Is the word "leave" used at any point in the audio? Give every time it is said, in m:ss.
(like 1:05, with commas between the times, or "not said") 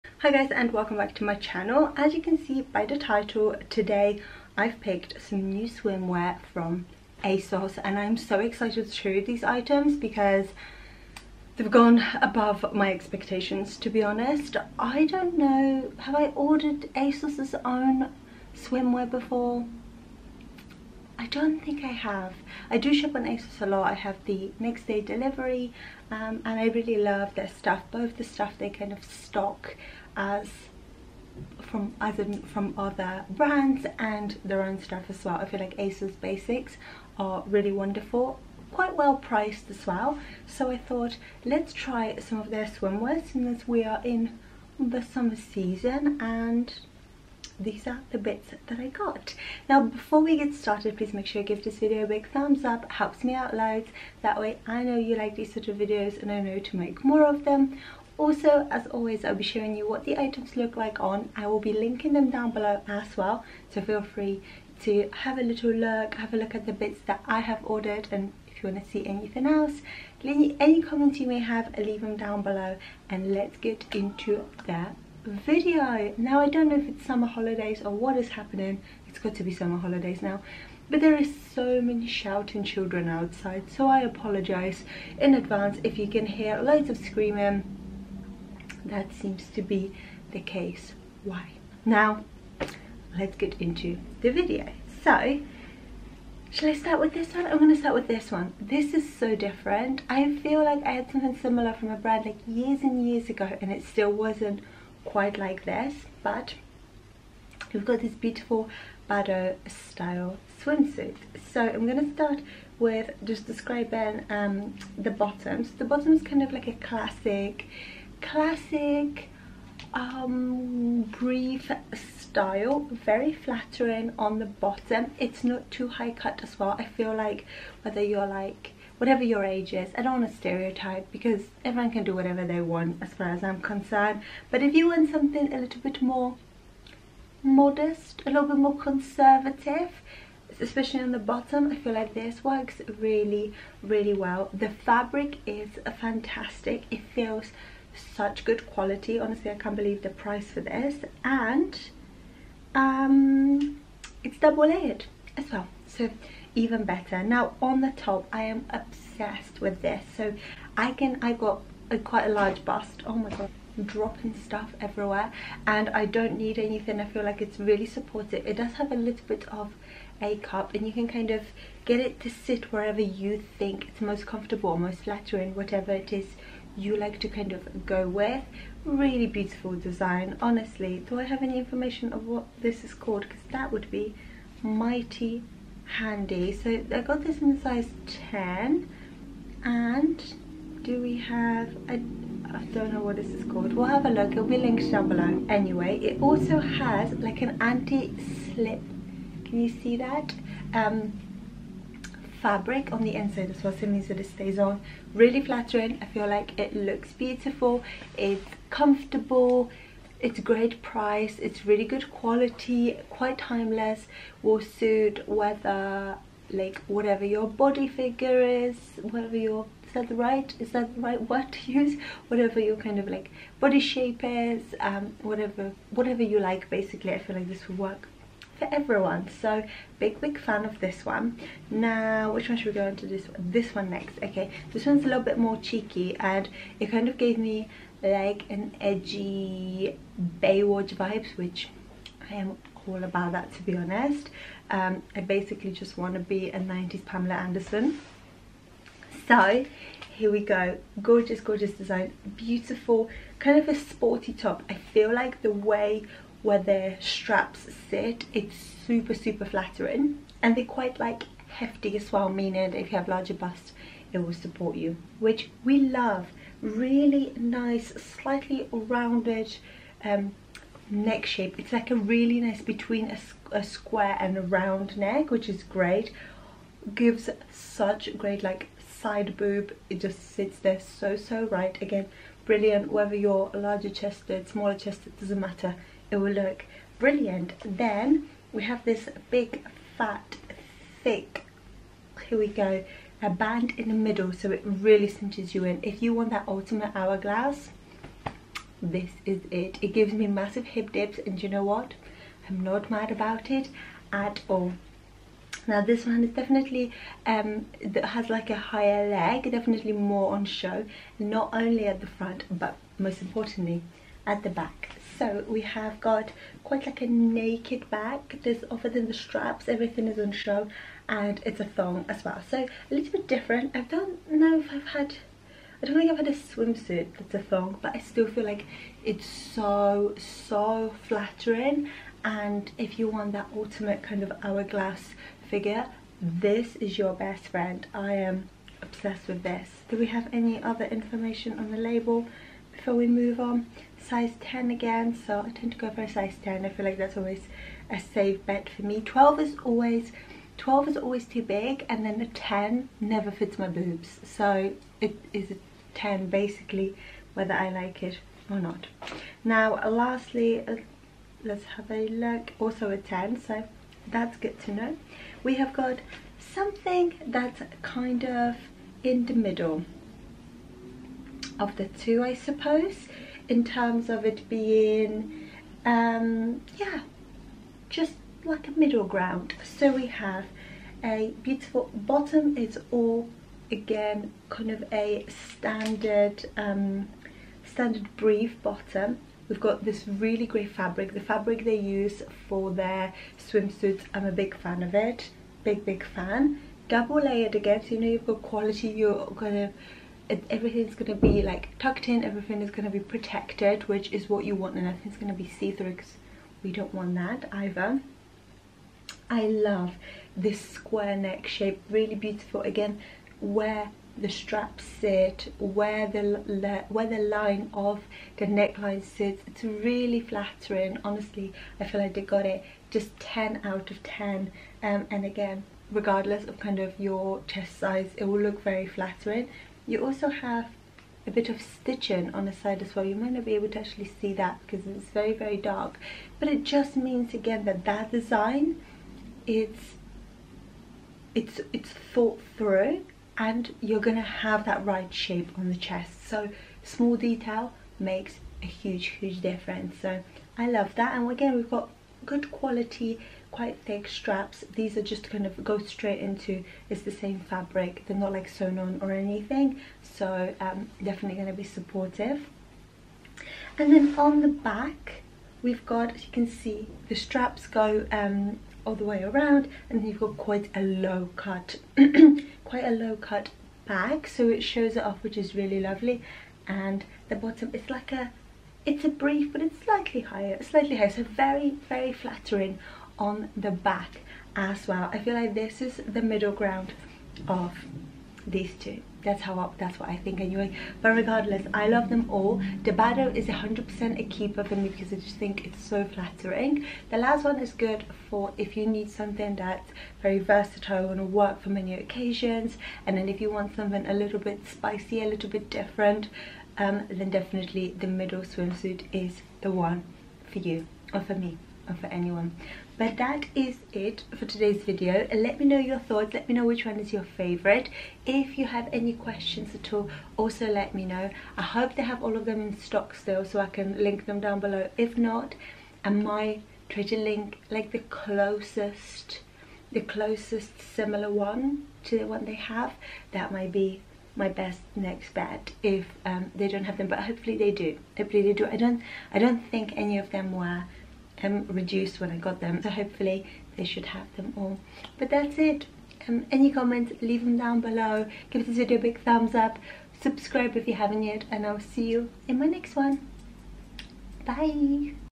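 1:11, 9:07.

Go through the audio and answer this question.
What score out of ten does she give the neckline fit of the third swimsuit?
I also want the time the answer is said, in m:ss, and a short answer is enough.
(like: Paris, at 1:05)
10 out of 10, at 7:03.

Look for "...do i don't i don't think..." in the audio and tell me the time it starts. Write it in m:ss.
8:58.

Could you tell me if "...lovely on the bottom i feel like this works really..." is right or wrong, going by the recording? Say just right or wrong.
wrong.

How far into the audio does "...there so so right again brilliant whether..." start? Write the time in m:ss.
4:40.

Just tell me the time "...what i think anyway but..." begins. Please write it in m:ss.
8:09.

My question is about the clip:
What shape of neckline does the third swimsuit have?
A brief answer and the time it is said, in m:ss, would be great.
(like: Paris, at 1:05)
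square neck, at 6:50.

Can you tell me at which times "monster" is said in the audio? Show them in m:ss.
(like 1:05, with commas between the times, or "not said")
not said.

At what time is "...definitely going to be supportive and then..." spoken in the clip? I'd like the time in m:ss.
7:41.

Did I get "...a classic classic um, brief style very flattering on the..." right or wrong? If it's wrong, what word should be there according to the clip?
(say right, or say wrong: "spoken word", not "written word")
right.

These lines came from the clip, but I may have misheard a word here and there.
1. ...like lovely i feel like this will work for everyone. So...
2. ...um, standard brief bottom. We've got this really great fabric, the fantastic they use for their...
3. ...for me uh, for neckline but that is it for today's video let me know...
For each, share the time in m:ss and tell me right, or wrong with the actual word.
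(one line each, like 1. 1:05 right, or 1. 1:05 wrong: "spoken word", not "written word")
1. 3:46 wrong: "basically", not "lovely"
2. 6:26 wrong: "fabric", not "fantastic"
3. 8:31 wrong: "anyone", not "neckline".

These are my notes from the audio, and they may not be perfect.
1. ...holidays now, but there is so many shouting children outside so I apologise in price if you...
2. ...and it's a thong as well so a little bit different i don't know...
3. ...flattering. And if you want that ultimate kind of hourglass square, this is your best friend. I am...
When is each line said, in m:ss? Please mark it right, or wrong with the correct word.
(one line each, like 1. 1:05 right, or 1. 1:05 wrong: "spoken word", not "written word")
1. 1:19 wrong: "advance", not "price"
2. 5:21 right
3. 5:31 wrong: "figure", not "square".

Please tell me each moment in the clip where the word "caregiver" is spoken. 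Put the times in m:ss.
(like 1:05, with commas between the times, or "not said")
not said.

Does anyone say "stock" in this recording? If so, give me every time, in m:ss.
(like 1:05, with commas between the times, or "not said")
0:29, 8:42.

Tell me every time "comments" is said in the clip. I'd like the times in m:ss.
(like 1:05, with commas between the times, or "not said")
1:10, 9:06.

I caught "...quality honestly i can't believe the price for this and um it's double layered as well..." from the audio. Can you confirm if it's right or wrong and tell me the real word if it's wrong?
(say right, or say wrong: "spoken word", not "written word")
right.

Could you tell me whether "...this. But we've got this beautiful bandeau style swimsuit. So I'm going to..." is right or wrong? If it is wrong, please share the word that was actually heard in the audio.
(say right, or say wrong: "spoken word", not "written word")
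right.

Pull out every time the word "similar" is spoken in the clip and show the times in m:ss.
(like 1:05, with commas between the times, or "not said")
1:41, 8:50.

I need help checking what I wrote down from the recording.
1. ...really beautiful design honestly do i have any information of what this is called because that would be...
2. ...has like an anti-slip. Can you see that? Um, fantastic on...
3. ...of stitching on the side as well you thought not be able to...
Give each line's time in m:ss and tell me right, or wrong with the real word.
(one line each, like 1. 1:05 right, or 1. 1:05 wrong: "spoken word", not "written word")
1. 2:58 right
2. 3:16 wrong: "fabric", not "fantastic"
3. 7:11 wrong: "might", not "thought".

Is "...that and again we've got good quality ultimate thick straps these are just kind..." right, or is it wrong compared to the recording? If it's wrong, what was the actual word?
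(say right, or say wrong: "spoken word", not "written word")
wrong: "quite", not "ultimate".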